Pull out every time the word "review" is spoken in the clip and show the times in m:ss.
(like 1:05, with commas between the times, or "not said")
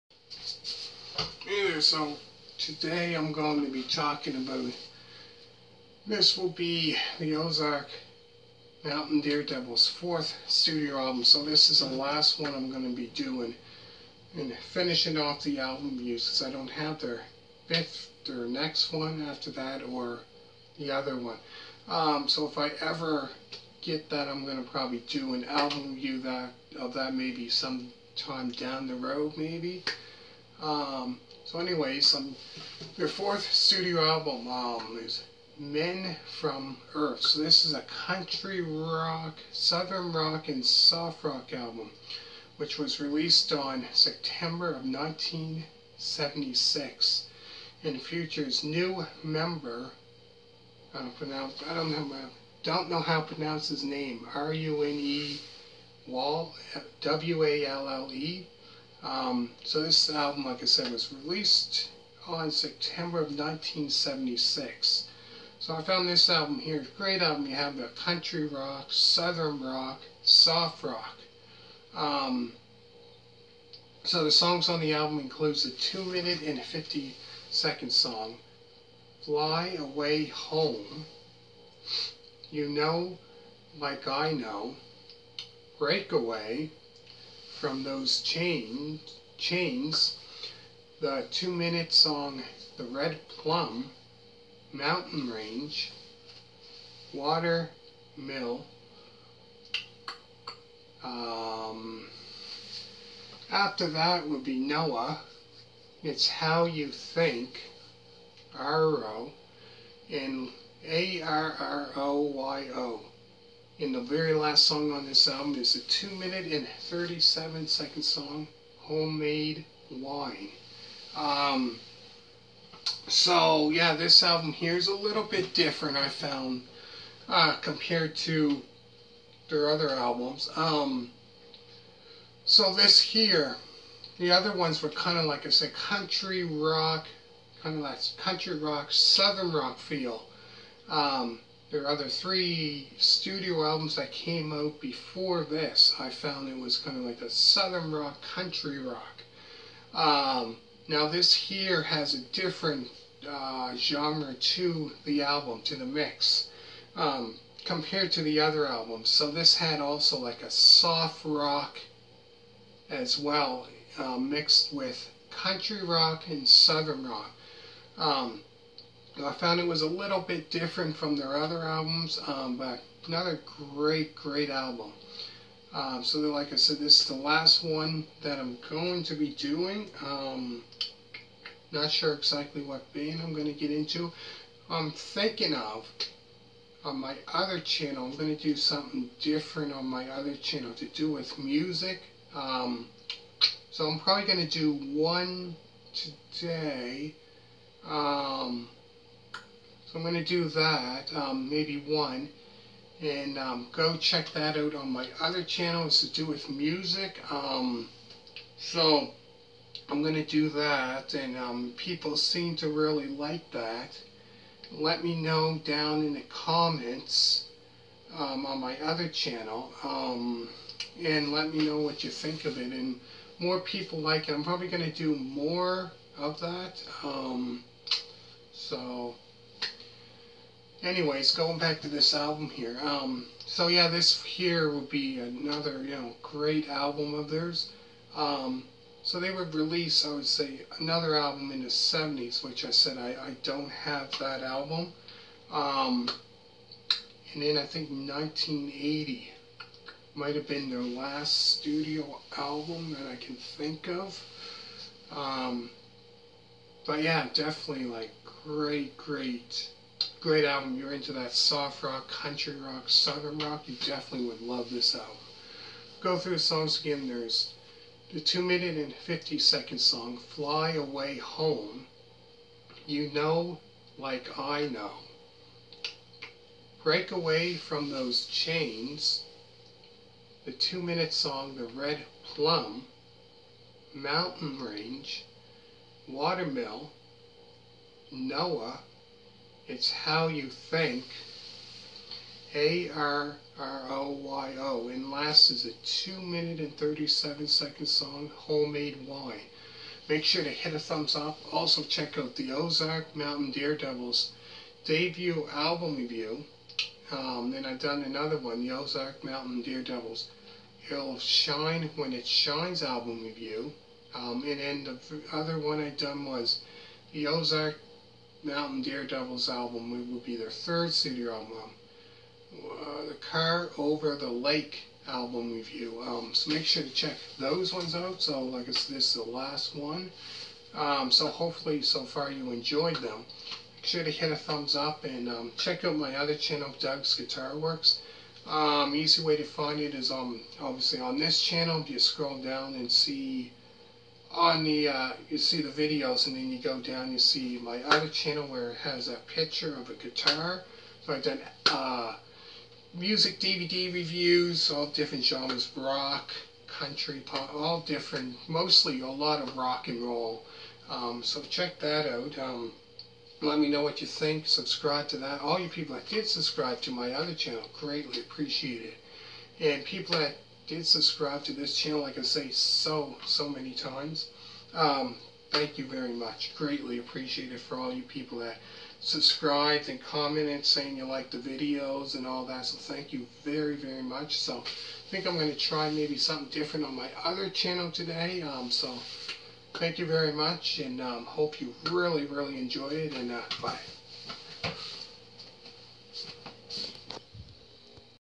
5:05, 5:13, 5:25, 5:53.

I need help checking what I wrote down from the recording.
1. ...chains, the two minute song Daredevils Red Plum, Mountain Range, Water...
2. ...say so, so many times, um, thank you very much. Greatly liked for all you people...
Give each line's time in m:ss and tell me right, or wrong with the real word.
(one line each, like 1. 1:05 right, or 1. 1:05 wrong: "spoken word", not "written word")
1. 1:29 wrong: "The", not "Daredevils"
2. 6:12 wrong: "appreciated", not "liked".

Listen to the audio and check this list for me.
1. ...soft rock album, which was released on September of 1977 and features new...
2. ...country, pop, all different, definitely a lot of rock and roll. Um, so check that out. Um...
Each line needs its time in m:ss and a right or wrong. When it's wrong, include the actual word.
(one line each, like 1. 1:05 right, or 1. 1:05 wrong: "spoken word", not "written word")
1. 0:40 wrong: "1976", not "1977"
2. 5:56 wrong: "mostly", not "definitely".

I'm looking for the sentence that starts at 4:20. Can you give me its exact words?
You're into that soft rock, country rock, southern rock.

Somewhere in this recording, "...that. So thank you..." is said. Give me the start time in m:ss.
6:22.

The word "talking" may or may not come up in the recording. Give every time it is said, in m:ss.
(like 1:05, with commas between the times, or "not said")
0:03.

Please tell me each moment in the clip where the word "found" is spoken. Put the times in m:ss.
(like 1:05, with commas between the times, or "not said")
1:05, 2:06, 2:26, 2:49.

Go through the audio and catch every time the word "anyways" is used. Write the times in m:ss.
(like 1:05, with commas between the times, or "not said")
0:31, 3:50.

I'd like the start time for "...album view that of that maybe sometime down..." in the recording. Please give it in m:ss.
0:25.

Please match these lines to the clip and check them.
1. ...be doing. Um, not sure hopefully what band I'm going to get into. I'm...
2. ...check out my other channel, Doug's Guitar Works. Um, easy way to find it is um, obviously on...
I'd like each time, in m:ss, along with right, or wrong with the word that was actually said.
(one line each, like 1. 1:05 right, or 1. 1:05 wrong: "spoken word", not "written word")
1. 2:59 wrong: "exactly", not "hopefully"
2. 5:35 right.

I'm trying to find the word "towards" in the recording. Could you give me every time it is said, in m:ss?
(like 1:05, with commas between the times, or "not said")
not said.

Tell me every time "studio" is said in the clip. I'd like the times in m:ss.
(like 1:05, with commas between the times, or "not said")
0:10, 0:33, 2:22, 4:11, 5:20.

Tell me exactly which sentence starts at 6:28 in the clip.
Um, so thank you very much and um, hope you really, really enjoy it.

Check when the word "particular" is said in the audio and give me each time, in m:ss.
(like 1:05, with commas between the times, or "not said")
not said.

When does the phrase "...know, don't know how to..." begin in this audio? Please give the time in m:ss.
0:51.